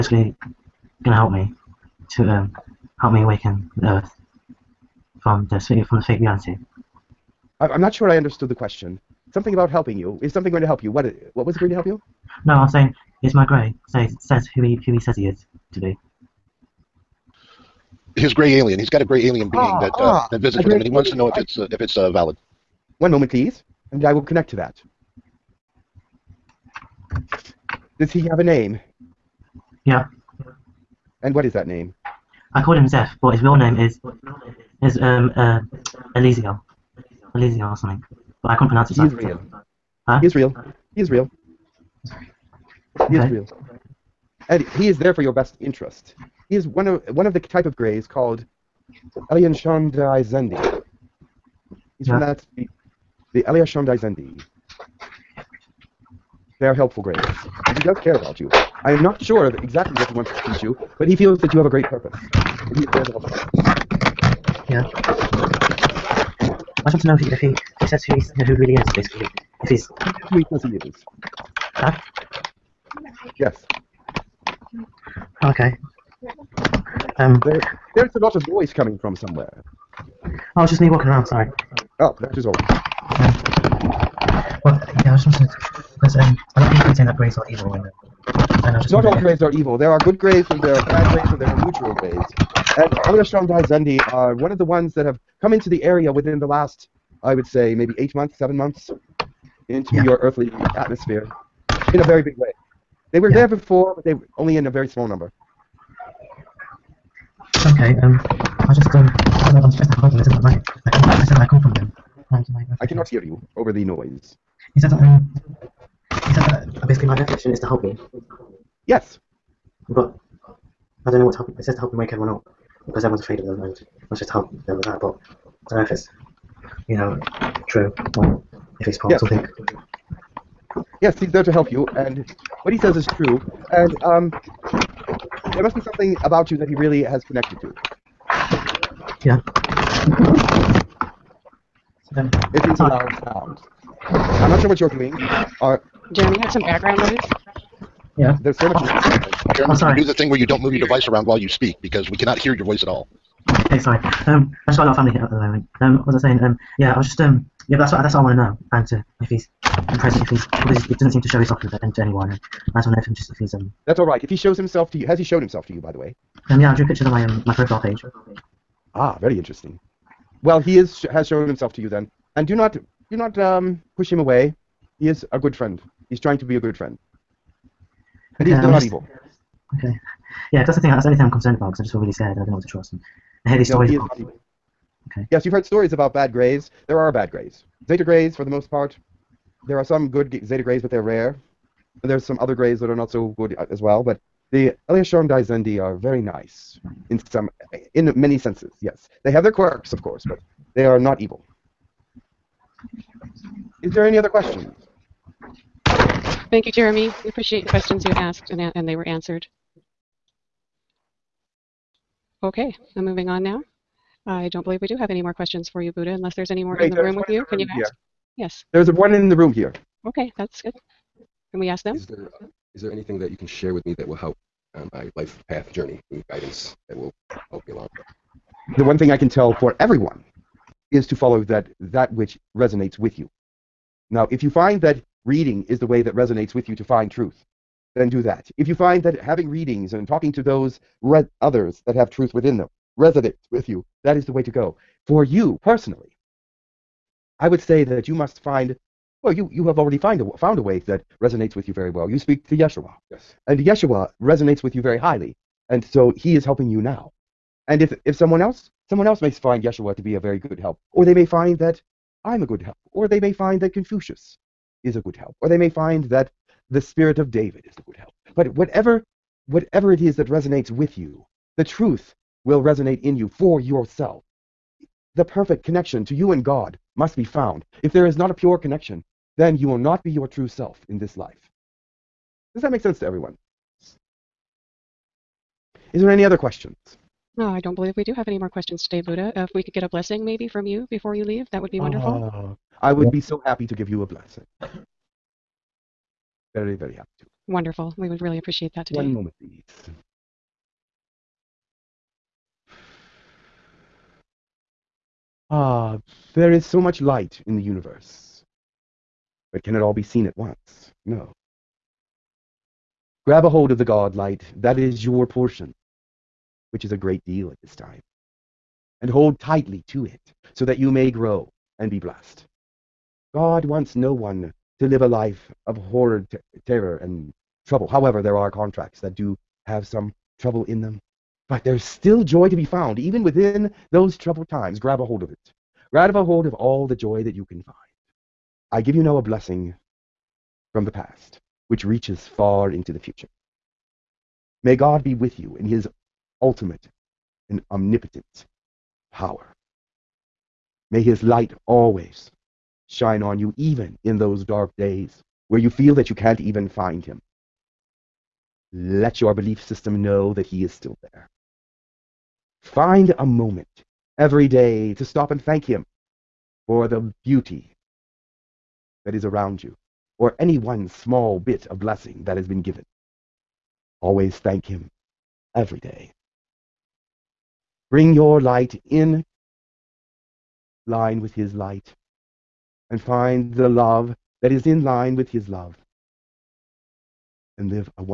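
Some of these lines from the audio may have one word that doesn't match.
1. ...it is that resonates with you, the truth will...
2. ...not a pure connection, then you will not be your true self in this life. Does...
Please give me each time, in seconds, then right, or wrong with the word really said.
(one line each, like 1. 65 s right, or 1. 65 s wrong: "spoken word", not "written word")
1. 269 s right
2. 278 s right.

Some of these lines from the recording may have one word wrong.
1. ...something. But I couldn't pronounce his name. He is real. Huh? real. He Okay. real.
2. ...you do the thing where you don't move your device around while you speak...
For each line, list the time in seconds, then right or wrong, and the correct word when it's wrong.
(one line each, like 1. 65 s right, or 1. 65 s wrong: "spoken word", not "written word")
1. 37 s right
2. 149 s right.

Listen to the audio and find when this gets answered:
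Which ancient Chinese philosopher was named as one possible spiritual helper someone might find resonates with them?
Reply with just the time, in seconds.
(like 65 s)
263 s.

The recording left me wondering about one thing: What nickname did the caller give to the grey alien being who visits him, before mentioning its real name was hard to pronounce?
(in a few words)
Zeph.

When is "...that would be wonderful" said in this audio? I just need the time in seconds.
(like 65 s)
291 s.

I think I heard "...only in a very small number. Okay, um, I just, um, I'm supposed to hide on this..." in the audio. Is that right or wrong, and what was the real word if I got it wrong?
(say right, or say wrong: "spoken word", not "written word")
right.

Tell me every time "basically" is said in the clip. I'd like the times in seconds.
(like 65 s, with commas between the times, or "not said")
68 s, 116 s.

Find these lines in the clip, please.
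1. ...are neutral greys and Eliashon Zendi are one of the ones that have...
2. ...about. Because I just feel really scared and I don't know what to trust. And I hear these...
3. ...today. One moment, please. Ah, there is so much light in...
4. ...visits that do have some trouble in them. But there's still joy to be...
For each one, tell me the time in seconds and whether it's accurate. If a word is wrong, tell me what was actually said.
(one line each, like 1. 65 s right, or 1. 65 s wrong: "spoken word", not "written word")
1. 91 s right
2. 181 s right
3. 298 s right
4. 328 s wrong: "contracts", not "visits".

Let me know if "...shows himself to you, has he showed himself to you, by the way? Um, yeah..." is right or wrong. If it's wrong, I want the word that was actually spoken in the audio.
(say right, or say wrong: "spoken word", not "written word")
right.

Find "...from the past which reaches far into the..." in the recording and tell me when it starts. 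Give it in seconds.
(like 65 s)
340 s.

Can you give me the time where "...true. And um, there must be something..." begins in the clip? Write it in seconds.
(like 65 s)
133 s.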